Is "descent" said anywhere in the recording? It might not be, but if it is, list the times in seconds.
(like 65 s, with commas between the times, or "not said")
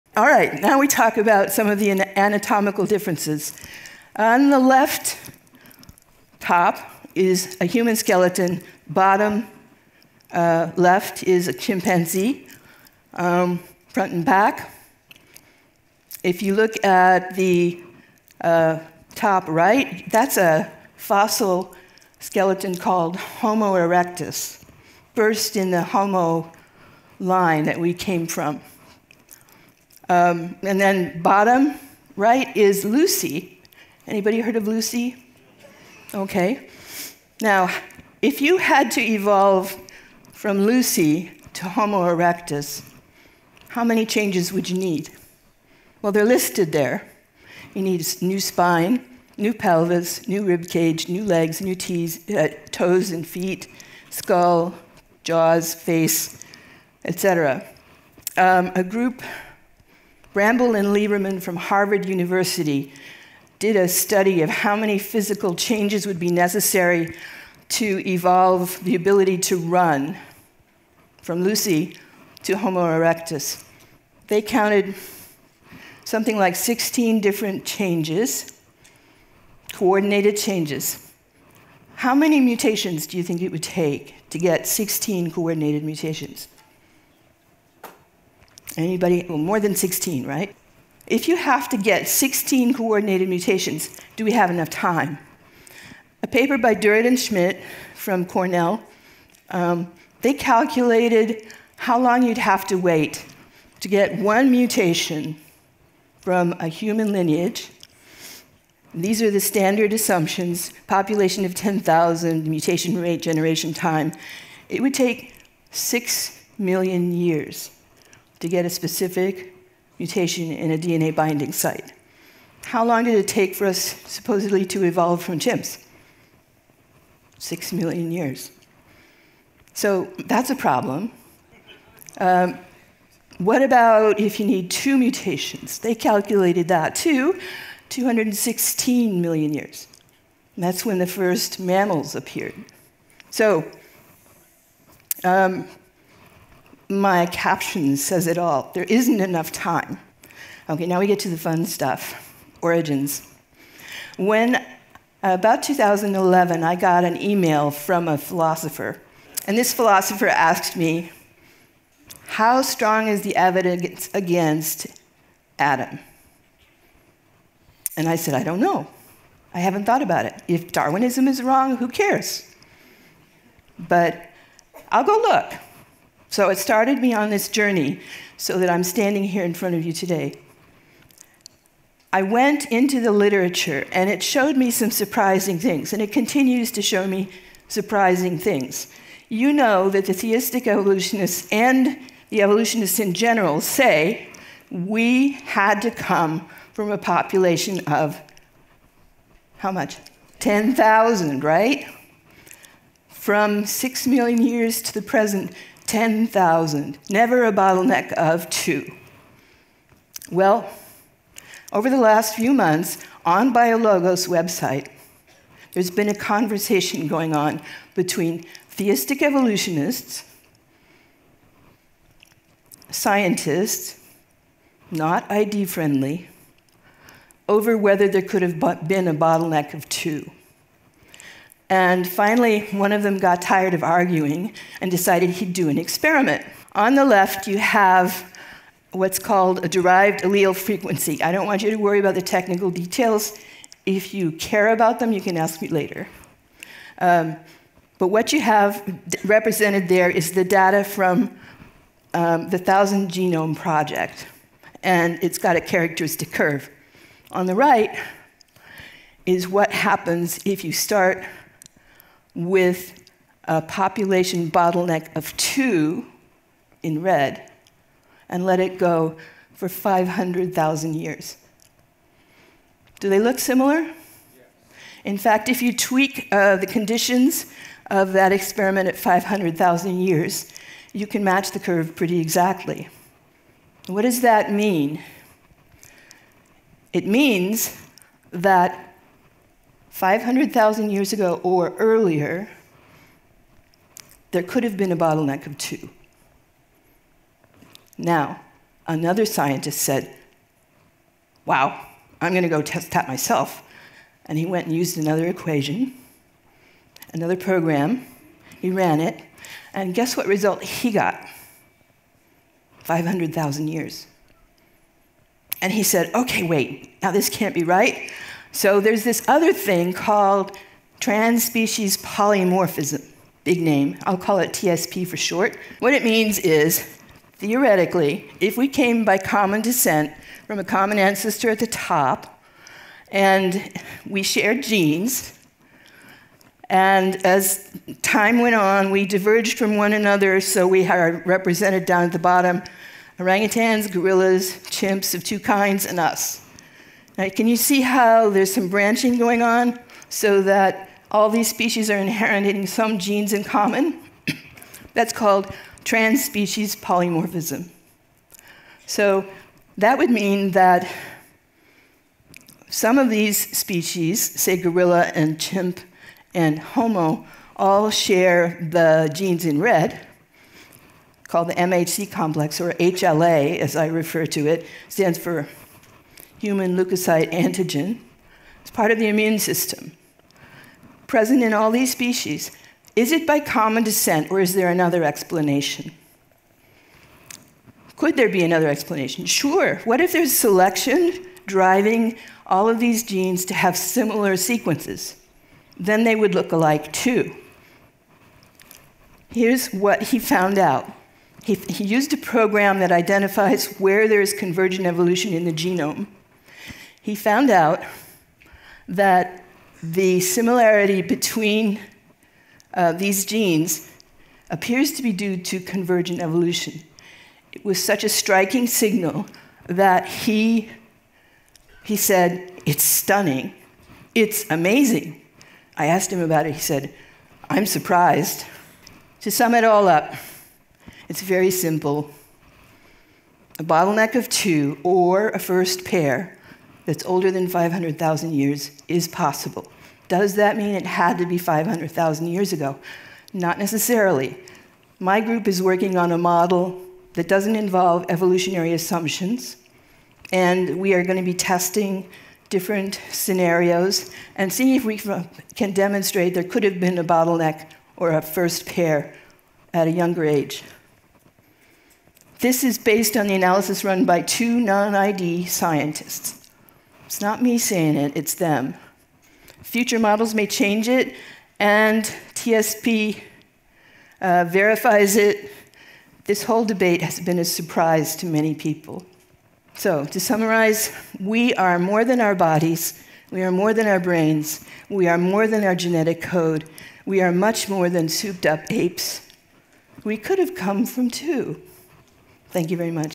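329 s, 383 s.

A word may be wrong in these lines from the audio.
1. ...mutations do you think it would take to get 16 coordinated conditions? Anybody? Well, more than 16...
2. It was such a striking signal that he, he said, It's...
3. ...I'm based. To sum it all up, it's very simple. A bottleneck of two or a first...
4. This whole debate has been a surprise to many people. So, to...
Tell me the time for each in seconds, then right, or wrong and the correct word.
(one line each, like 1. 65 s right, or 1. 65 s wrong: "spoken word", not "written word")
1. 82 s wrong: "mutations", not "conditions"
2. 417 s right
3. 427 s wrong: "surprised", not "based"
4. 476 s right.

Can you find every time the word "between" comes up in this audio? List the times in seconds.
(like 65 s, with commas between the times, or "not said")
217 s, 411 s.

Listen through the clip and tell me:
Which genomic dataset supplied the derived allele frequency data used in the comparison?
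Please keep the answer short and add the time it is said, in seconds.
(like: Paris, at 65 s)
Thousand Genome Project, at 252 s.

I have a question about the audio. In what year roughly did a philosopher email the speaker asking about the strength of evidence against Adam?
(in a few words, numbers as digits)
2011.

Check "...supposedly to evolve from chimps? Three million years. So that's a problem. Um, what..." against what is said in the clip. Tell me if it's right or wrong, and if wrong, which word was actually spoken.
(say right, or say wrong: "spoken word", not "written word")
wrong: "Six", not "Three".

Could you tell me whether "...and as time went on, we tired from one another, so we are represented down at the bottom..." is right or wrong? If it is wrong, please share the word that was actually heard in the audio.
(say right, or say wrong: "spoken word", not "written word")
wrong: "diverged", not "tired".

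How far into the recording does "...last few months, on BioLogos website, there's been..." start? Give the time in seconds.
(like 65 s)
211 s.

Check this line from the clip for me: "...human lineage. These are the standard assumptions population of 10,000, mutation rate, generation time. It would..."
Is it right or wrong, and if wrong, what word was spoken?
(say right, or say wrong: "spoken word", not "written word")
right.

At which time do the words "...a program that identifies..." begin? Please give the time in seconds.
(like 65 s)
402 s.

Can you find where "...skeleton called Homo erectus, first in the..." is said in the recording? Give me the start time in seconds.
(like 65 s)
22 s.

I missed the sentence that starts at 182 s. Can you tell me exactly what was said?
I went into the literature and it showed me some surprising things, and it continues to show me surprising things.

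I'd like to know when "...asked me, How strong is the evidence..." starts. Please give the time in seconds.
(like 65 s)
160 s.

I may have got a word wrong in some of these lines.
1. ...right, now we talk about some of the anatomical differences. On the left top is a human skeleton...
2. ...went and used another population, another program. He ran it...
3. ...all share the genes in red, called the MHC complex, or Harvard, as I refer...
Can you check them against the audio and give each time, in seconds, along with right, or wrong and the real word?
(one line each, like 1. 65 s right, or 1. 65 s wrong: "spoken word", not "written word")
1. 0 s right
2. 304 s wrong: "equation", not "population"
3. 367 s wrong: "HLA", not "Harvard".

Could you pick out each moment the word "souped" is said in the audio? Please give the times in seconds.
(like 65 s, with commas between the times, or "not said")
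488 s.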